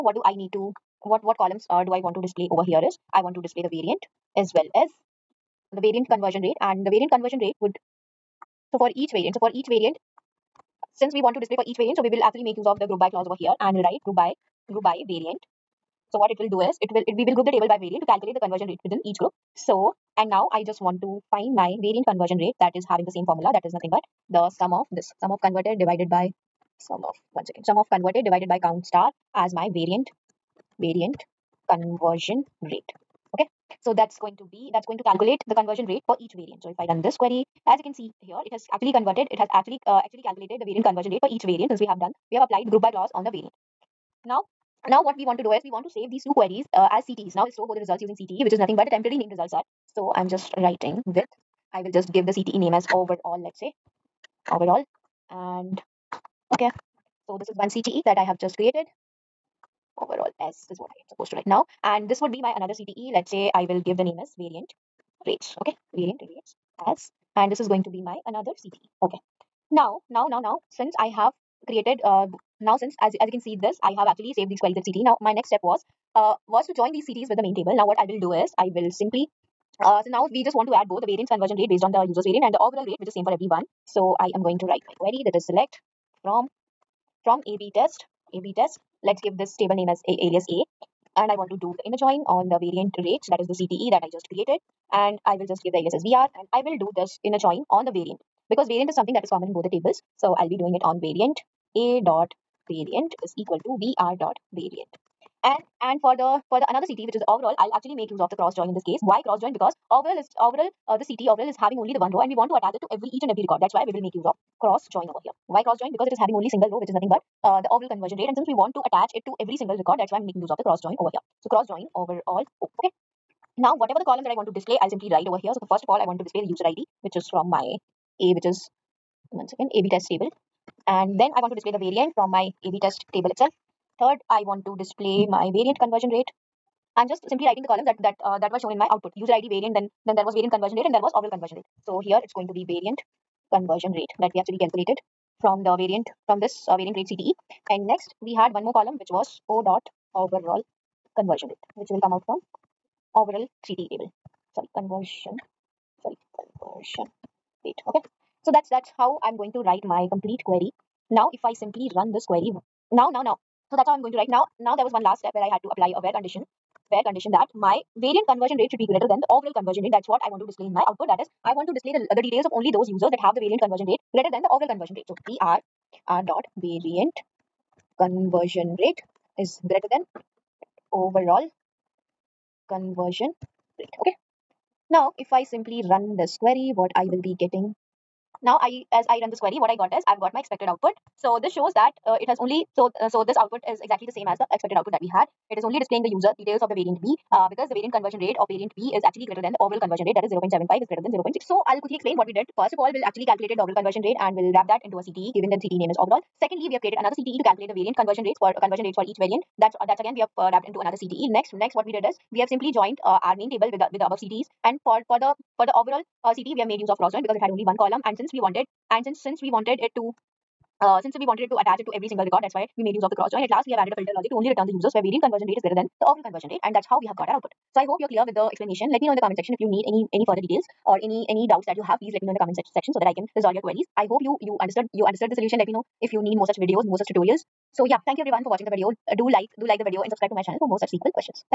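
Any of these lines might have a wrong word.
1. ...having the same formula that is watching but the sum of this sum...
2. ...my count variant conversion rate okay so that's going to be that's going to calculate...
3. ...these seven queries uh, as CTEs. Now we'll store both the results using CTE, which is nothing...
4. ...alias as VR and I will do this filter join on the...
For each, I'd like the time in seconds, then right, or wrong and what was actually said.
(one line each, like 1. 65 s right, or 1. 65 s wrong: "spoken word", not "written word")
1. 22 s wrong: "nothing", not "watching"
2. 29 s wrong: "variant", not "count"
3. 46 s wrong: "two", not "seven"
4. 95 s wrong: "inner", not "filter".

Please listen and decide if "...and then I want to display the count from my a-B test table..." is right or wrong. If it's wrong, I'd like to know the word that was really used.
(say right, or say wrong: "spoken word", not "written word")
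wrong: "variant", not "count".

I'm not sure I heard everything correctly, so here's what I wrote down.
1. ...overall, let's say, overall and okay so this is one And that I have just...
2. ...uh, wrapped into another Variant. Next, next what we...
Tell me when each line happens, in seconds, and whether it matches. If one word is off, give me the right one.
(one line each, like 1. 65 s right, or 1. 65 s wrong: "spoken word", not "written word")
1. 52 s wrong: "CTE", not "And"
2. 210 s wrong: "CTE", not "Variant".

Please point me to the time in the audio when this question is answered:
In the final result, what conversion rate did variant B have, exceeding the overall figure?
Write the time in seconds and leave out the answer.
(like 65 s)
200 s.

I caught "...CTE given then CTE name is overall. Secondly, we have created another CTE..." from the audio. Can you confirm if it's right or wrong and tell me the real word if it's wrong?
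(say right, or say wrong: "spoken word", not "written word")
right.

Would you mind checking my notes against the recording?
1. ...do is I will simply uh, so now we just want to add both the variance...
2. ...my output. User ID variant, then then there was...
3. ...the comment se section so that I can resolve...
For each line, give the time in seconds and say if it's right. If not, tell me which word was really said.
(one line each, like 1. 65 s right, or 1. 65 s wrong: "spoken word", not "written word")
1. 78 s right
2. 138 s right
3. 232 s right.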